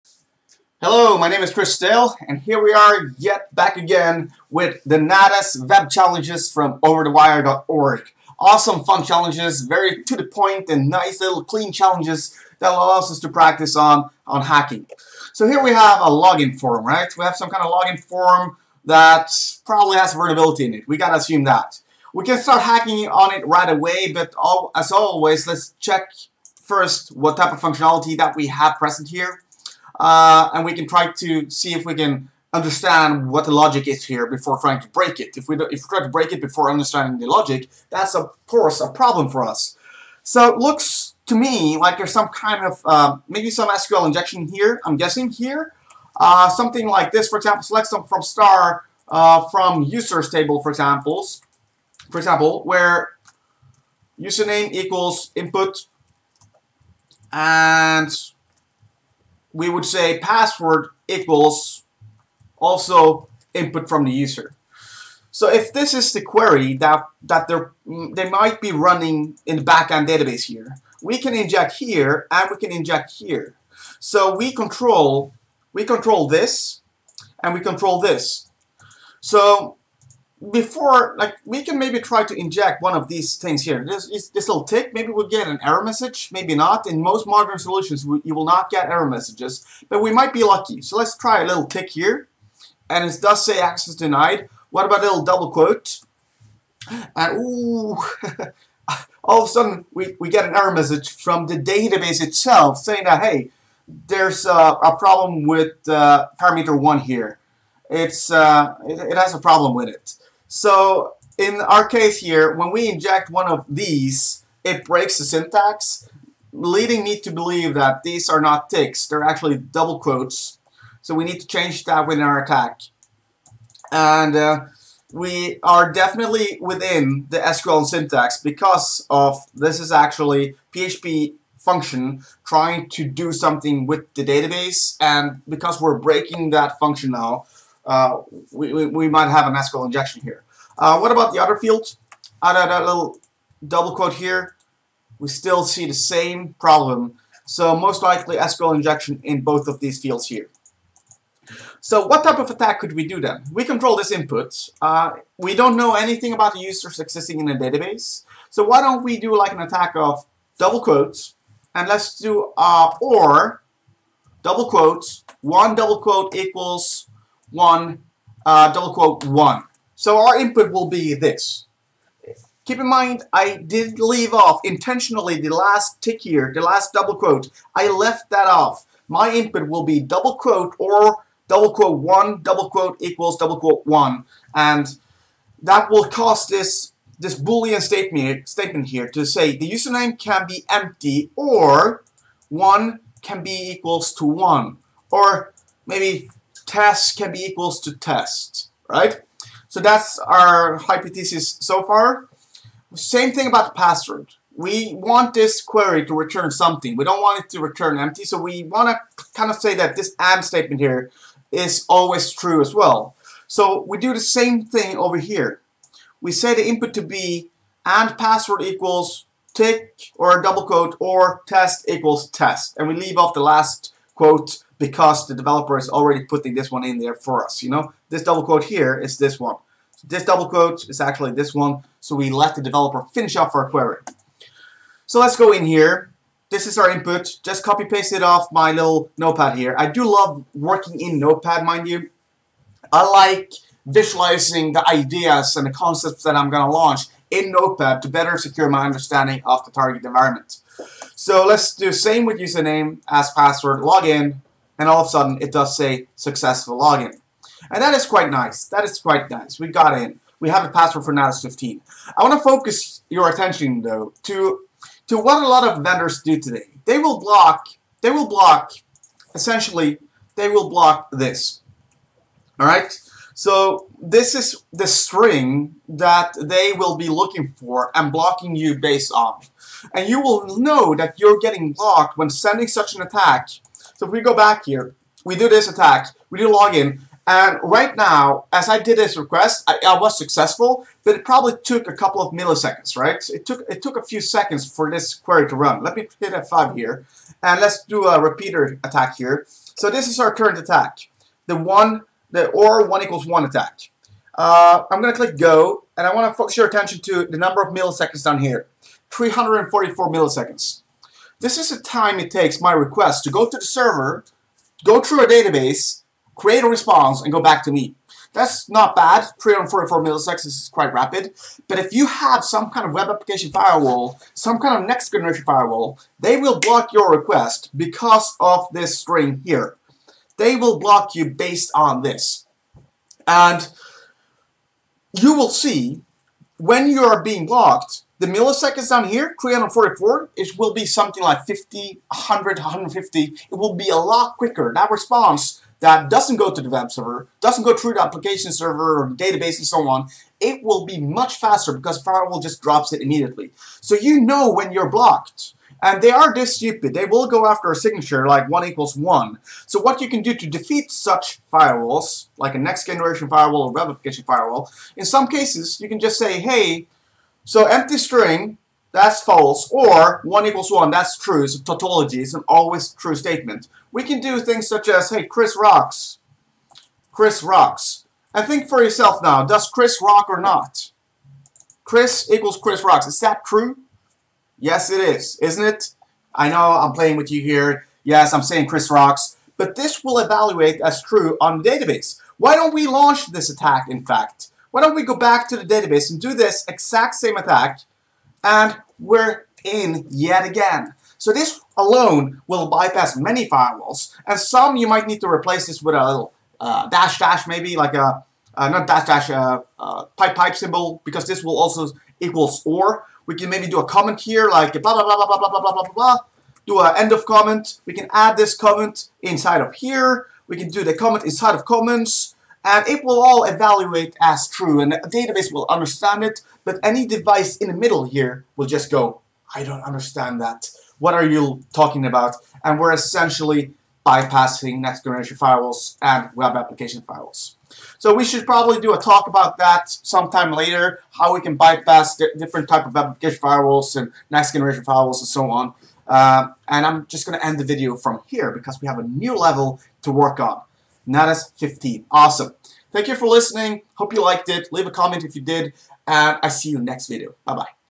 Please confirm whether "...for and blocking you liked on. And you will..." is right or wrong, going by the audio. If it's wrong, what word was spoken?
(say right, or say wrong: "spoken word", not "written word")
wrong: "based", not "liked".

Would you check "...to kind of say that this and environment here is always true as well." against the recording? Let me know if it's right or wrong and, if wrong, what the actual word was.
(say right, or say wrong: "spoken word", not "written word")
wrong: "statement", not "environment".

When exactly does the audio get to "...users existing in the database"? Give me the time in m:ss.
2:36.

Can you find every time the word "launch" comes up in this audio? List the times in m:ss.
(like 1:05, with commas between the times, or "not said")
4:06, 6:32.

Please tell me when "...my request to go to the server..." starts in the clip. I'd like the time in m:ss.
5:12.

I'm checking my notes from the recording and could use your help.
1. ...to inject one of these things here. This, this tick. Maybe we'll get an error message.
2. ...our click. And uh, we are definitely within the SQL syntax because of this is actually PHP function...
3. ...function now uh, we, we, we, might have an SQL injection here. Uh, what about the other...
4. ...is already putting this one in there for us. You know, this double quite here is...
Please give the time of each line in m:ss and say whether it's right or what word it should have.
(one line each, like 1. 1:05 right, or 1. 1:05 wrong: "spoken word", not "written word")
1. 1:22 right
2. 2:02 wrong: "attack", not "click"
3. 2:16 right
4. 3:45 wrong: "quote", not "quite".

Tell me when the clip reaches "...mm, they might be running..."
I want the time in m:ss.
1:07.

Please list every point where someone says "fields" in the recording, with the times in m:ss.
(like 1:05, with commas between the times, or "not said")
2:21, 2:29.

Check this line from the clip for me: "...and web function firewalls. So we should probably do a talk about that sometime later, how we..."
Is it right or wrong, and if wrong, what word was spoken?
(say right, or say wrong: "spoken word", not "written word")
wrong: "application", not "function".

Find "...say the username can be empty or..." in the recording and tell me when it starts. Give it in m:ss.
3:09.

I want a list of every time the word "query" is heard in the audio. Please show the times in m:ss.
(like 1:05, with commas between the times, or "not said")
1:06, 3:25, 3:53, 4:55.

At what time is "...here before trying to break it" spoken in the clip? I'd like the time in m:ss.
0:34.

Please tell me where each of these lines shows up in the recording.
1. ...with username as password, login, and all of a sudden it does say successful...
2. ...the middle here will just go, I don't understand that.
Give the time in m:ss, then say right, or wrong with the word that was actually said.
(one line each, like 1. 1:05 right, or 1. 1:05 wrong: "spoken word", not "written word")
1. 4:12 right
2. 7:07 right.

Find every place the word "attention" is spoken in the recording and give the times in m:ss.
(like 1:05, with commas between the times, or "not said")
4:23, 5:06.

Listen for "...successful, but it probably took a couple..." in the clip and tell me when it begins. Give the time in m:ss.
4:50.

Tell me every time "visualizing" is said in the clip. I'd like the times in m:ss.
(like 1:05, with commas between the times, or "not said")
4:03.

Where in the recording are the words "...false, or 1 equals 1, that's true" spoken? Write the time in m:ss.
6:09.